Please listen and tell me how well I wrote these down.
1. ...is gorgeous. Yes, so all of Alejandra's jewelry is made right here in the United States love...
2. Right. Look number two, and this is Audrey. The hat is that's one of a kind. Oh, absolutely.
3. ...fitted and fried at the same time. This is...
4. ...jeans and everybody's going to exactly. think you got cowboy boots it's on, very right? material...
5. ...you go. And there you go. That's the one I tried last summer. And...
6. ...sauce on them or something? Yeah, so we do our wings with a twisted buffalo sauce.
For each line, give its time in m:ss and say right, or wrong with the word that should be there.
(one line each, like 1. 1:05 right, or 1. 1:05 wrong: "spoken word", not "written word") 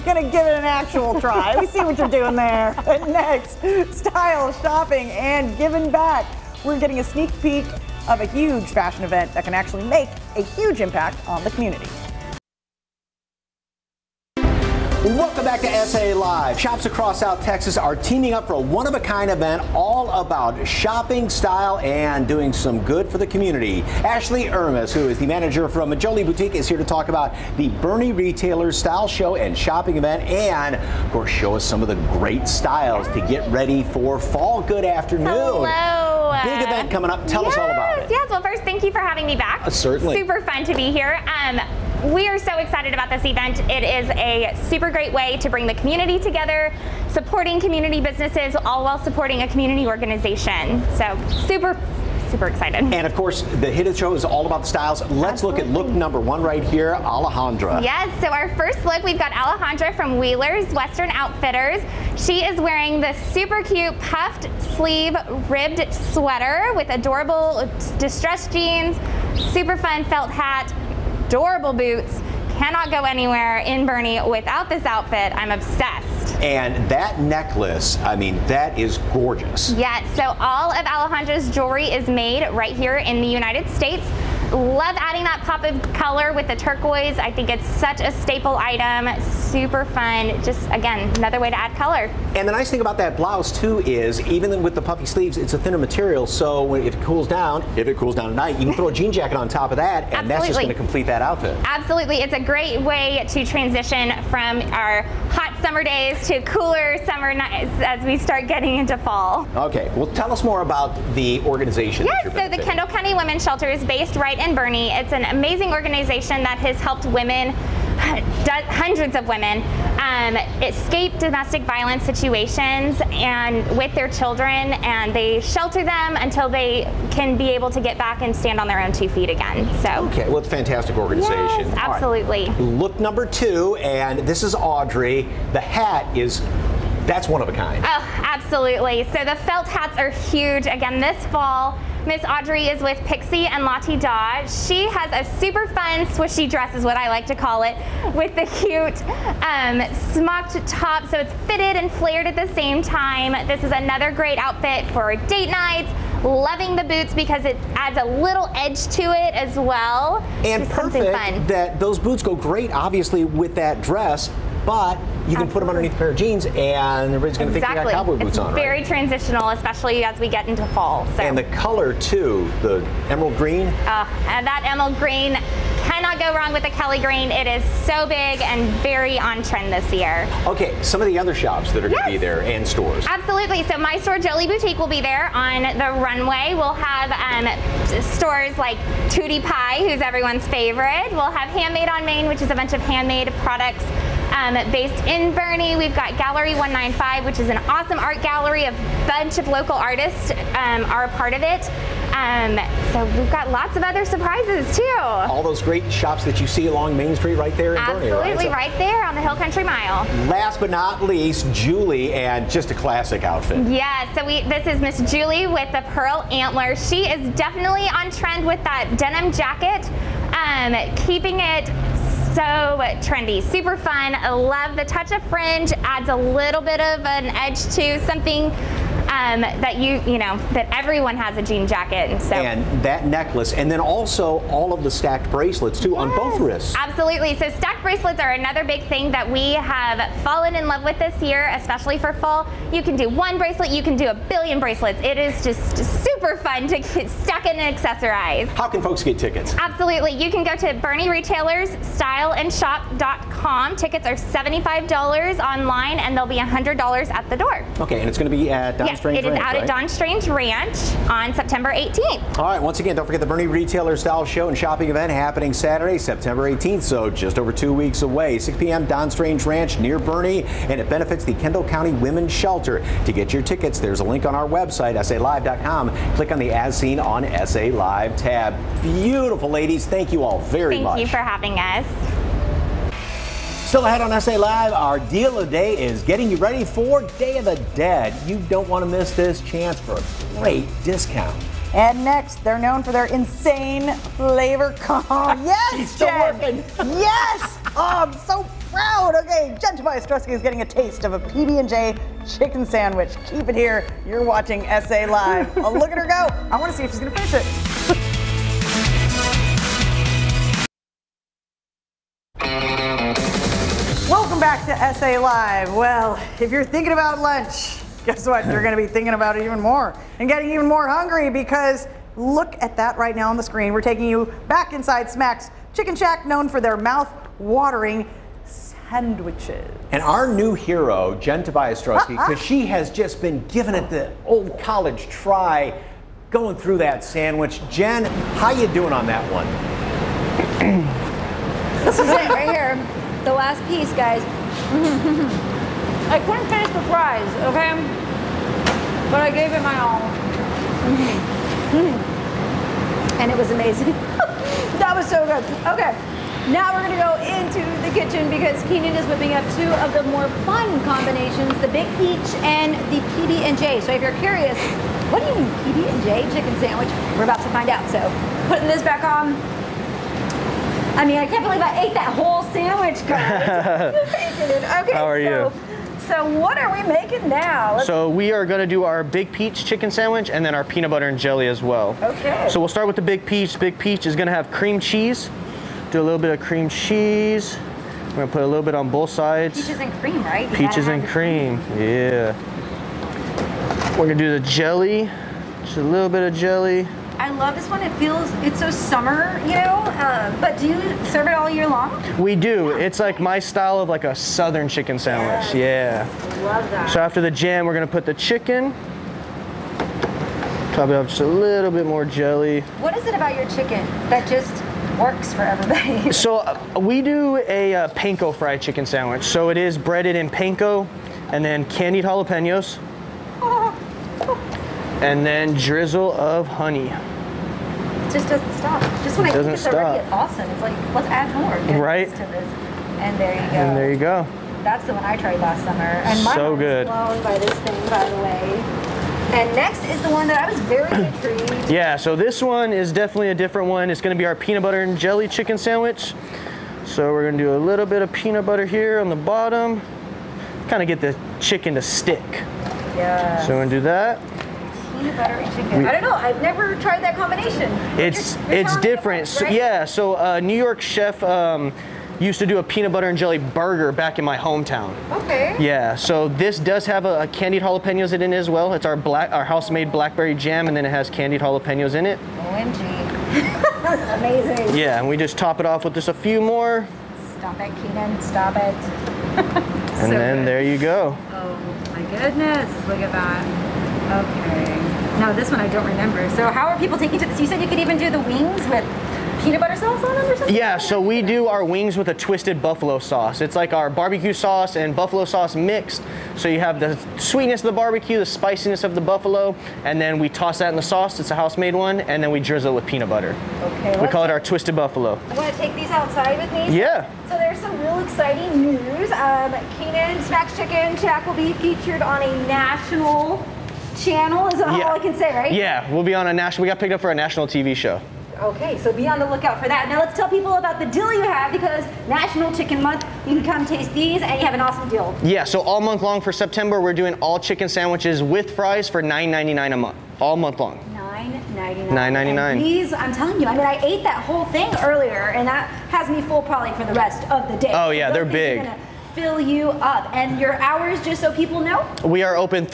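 1. 1:18 right
2. 2:12 right
3. 2:31 wrong: "flared", not "fried"
4. 2:46 wrong: "transitional", not "material"
5. 7:13 right
6. 8:09 right.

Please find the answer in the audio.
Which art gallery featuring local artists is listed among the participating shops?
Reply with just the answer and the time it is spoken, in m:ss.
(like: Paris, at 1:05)
Gallery 195, at 3:16.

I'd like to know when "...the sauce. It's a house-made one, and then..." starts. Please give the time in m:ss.
8:20.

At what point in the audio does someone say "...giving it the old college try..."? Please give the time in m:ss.
5:33.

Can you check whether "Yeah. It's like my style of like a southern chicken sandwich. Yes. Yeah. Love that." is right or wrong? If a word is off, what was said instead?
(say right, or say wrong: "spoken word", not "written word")
right.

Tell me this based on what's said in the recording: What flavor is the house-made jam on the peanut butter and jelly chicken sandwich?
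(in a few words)
blackberry.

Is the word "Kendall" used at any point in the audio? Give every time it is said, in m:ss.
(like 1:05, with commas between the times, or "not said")
1:52, 4:31.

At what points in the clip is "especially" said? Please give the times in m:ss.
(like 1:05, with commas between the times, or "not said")
2:49, 4:01.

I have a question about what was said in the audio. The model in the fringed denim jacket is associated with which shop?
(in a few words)
Pearl Antler.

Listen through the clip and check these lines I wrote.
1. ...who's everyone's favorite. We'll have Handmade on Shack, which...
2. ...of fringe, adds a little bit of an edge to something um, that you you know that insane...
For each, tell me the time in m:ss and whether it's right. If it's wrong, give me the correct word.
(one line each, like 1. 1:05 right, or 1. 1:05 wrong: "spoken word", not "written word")
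1. 3:09 wrong: "Main", not "Shack"
2. 3:45 wrong: "everyone", not "insane".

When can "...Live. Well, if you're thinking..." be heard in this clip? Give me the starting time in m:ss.
5:15.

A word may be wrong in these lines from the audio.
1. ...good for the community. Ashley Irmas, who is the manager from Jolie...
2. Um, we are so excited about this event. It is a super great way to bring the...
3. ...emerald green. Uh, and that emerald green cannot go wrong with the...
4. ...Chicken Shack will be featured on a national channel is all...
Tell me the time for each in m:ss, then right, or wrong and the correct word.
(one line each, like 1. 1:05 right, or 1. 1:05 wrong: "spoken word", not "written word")
1. 0:22 right
2. 0:41 right
3. 2:53 right
4. 8:30 right.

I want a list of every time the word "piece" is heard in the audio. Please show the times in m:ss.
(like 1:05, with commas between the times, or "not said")
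5:43.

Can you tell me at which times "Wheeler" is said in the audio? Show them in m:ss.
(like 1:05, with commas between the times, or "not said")
1:00.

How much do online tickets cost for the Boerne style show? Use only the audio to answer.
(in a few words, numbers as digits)
$75.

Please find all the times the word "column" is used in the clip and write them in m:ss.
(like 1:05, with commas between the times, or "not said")
not said.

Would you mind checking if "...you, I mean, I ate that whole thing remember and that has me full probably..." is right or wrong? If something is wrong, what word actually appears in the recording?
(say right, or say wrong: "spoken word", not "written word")
wrong: "earlier", not "remember".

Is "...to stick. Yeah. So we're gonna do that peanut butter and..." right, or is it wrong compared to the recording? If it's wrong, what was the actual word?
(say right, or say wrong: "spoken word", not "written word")
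right.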